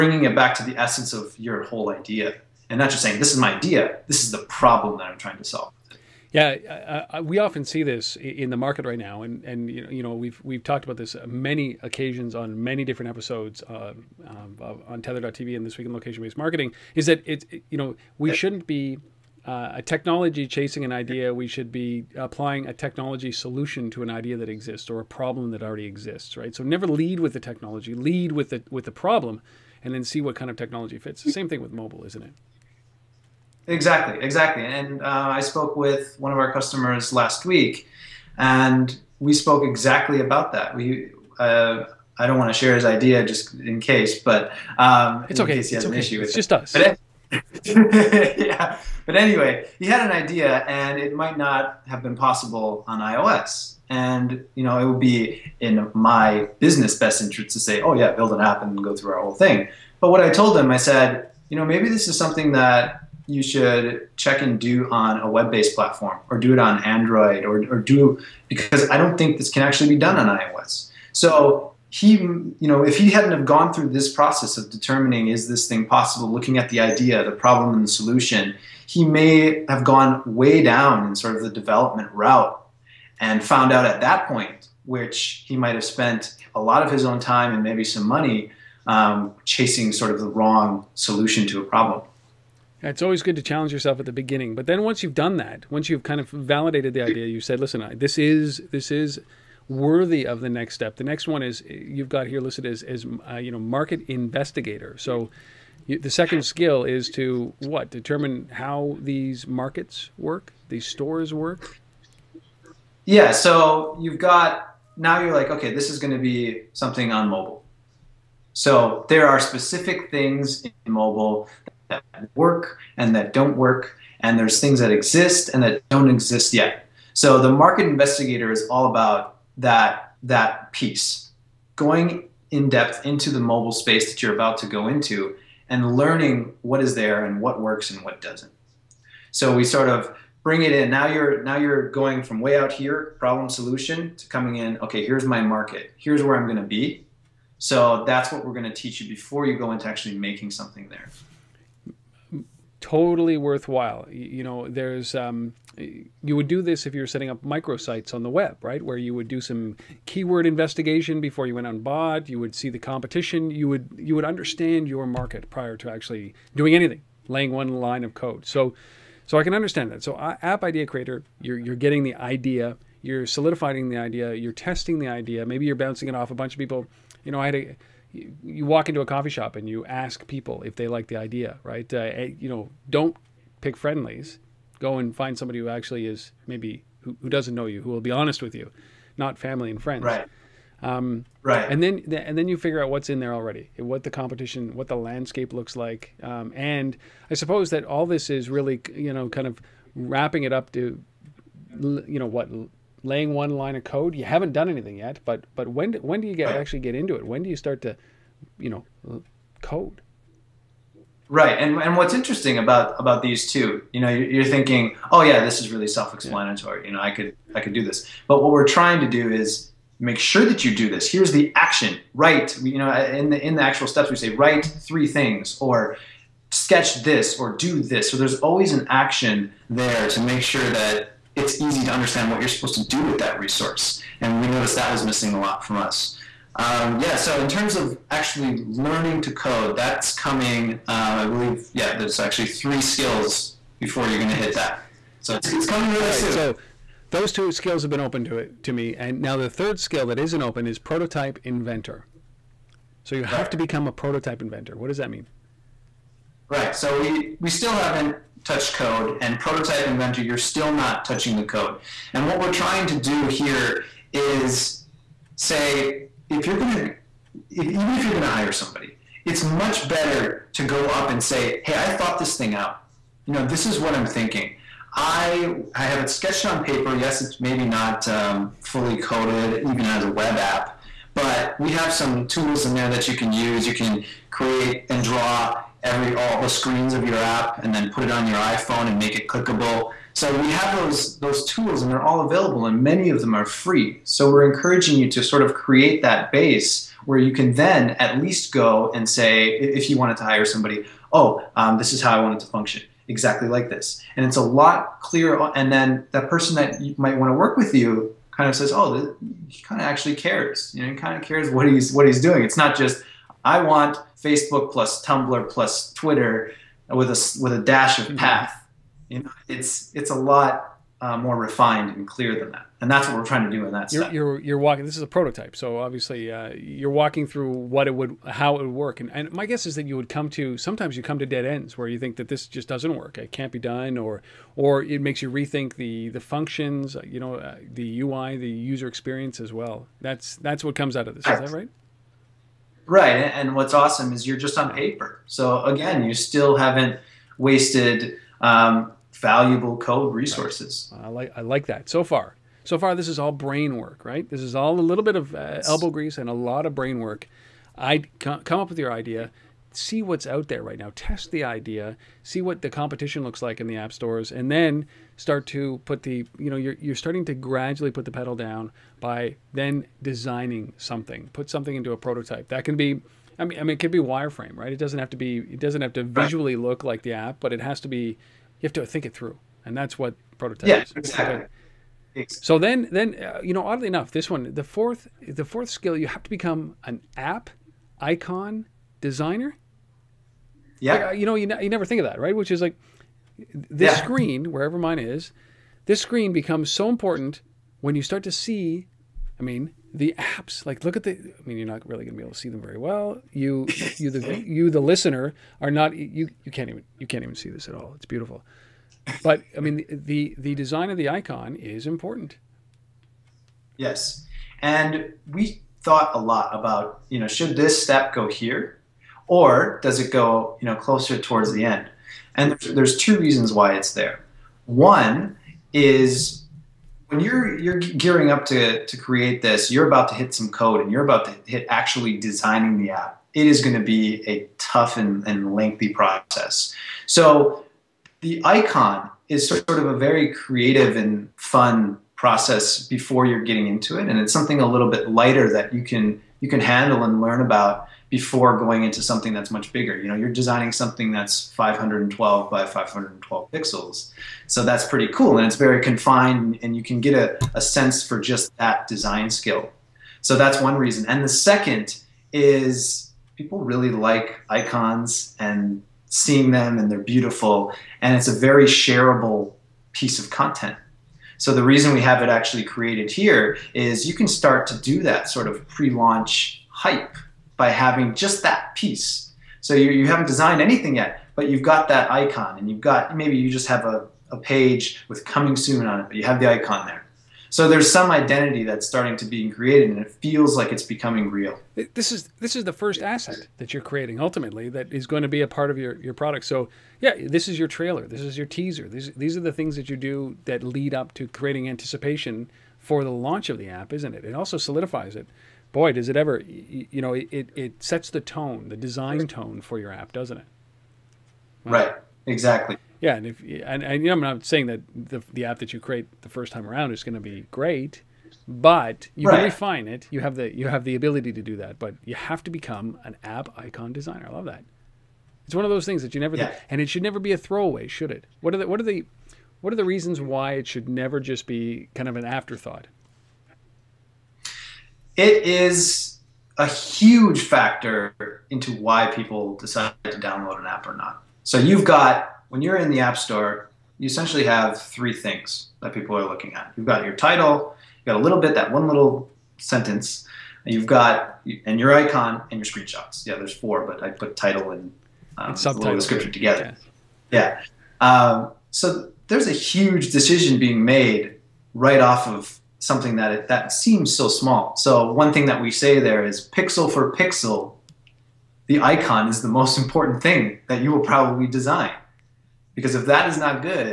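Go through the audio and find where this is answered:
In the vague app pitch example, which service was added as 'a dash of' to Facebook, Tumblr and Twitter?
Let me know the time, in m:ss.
5:18.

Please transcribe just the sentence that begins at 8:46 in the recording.
and it should never be a throwaway, should it?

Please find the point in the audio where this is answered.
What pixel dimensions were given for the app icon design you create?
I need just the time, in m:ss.
7:31.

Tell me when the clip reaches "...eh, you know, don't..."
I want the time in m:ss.
3:01.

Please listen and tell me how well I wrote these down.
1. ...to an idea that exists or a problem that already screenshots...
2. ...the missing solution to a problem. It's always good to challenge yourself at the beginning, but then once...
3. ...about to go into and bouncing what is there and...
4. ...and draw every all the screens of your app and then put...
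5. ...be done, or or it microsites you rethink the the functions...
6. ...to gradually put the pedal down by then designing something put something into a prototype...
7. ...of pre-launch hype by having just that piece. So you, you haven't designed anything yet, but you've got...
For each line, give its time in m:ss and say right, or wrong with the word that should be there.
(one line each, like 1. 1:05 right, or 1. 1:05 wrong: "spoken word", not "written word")
1. 0:23 wrong: "exists", not "screenshots"
2. 1:30 wrong: "wrong", not "missing"
3. 2:14 wrong: "learning", not "bouncing"
4. 4:44 right
5. 5:33 wrong: "makes", not "microsites"
6. 6:07 right
7. 7:55 right.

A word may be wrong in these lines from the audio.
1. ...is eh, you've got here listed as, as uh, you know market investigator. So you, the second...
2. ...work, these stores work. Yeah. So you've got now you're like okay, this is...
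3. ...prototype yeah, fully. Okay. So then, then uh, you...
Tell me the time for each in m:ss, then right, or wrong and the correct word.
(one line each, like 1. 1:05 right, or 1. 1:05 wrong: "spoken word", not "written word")
1. 1:41 right
2. 1:50 right
3. 6:20 wrong: "exactly", not "fully".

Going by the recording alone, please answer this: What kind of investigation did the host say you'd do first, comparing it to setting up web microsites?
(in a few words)
keyword investigation.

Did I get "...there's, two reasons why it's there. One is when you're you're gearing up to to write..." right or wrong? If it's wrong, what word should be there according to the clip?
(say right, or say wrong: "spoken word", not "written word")
wrong: "create", not "write".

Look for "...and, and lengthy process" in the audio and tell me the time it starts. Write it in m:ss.
7:14.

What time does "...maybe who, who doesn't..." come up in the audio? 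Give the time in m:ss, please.
3:06.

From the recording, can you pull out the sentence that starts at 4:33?
You know, this is what I'm thinking.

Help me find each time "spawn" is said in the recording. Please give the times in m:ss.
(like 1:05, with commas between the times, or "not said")
not said.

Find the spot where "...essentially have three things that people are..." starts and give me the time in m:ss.
9:04.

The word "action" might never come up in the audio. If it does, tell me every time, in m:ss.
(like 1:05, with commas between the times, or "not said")
3:41, 3:48.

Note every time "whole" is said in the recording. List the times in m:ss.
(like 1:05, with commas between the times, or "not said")
0:01, 0:59.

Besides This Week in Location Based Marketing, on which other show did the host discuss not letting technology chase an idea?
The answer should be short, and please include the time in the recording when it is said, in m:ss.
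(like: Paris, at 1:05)
untether.tv, at 0:14.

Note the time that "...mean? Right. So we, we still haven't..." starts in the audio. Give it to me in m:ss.
4:15.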